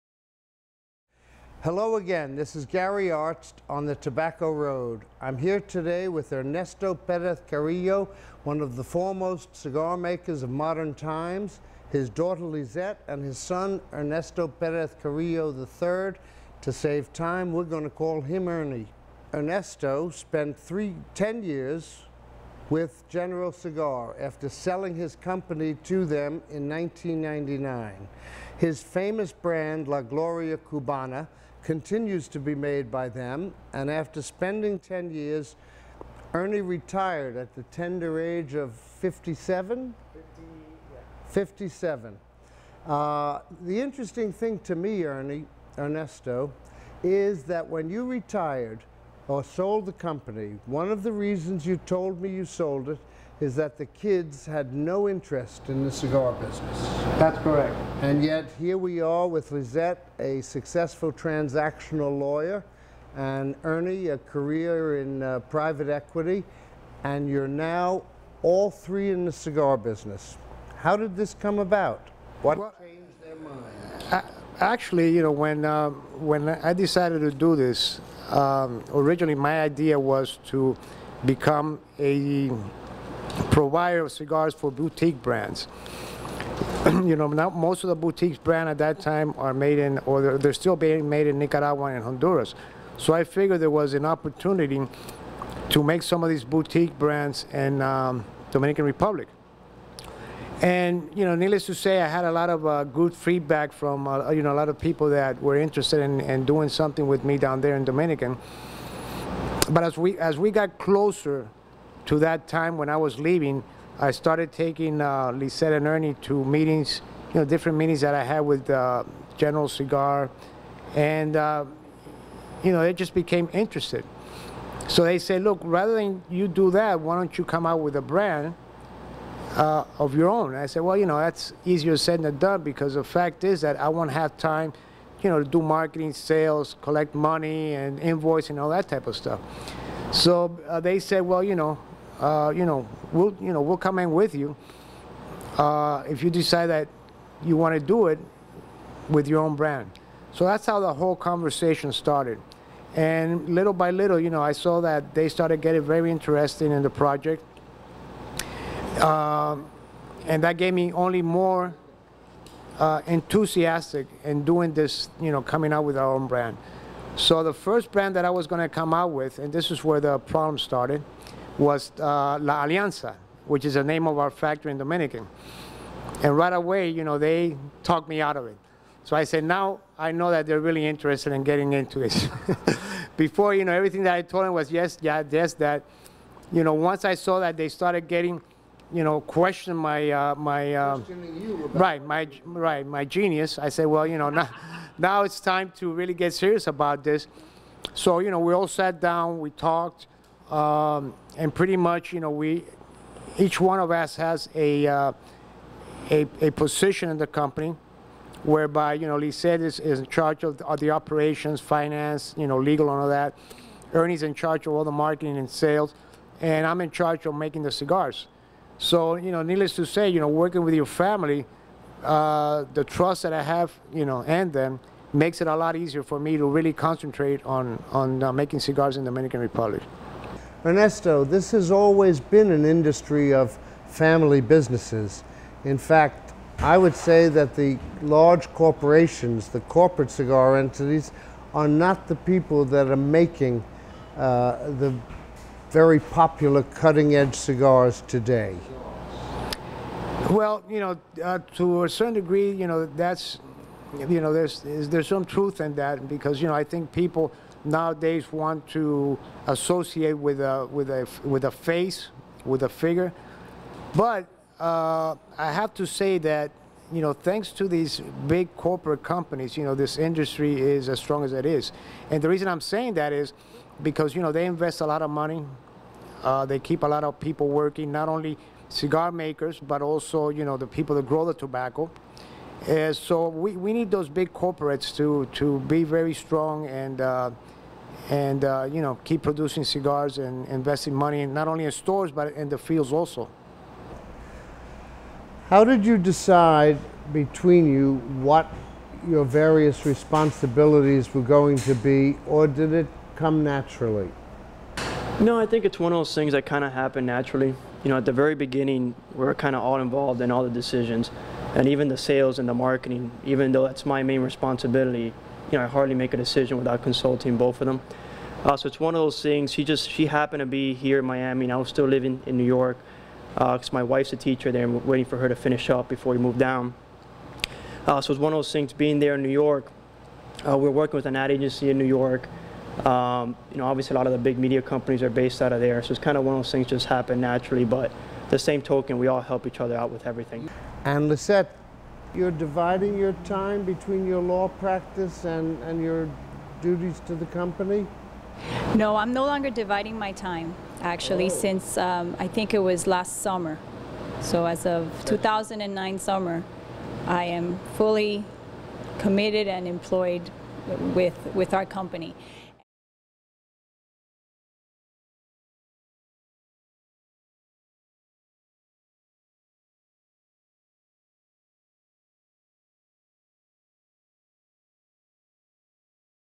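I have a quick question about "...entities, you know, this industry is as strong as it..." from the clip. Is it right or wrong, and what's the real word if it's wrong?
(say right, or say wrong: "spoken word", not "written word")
wrong: "companies", not "entities".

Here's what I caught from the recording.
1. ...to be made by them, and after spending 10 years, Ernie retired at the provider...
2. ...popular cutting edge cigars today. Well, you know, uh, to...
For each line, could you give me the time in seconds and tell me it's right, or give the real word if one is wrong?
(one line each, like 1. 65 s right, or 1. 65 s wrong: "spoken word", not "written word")
1. 32 s wrong: "tender", not "provider"
2. 245 s right.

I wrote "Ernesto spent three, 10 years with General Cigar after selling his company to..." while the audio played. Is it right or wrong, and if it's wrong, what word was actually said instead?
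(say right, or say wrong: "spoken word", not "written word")
right.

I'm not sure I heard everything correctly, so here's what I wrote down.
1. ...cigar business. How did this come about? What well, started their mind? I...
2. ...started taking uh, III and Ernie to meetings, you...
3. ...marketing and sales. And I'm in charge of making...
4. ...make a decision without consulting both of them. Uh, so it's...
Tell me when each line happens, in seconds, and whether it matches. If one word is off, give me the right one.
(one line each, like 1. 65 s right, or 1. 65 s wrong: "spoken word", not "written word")
1. 69 s wrong: "changed", not "started"
2. 114 s wrong: "Lissette", not "III"
3. 214 s right
4. 315 s right.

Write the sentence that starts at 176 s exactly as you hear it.
And right away, you know, they talked me out of it.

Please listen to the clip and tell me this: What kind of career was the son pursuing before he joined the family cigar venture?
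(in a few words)
Private equity.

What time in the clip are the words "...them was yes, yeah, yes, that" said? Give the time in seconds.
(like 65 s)
184 s.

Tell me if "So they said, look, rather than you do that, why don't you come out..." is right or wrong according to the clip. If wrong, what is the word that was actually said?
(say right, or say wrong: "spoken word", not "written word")
right.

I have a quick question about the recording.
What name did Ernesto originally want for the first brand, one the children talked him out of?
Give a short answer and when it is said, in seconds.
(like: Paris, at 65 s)
La Alianza, at 172 s.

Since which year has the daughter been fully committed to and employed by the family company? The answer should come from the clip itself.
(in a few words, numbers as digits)
2009.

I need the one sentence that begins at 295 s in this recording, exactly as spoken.
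How did you decide between you what your various responsibilities were going to be, or did it come naturally?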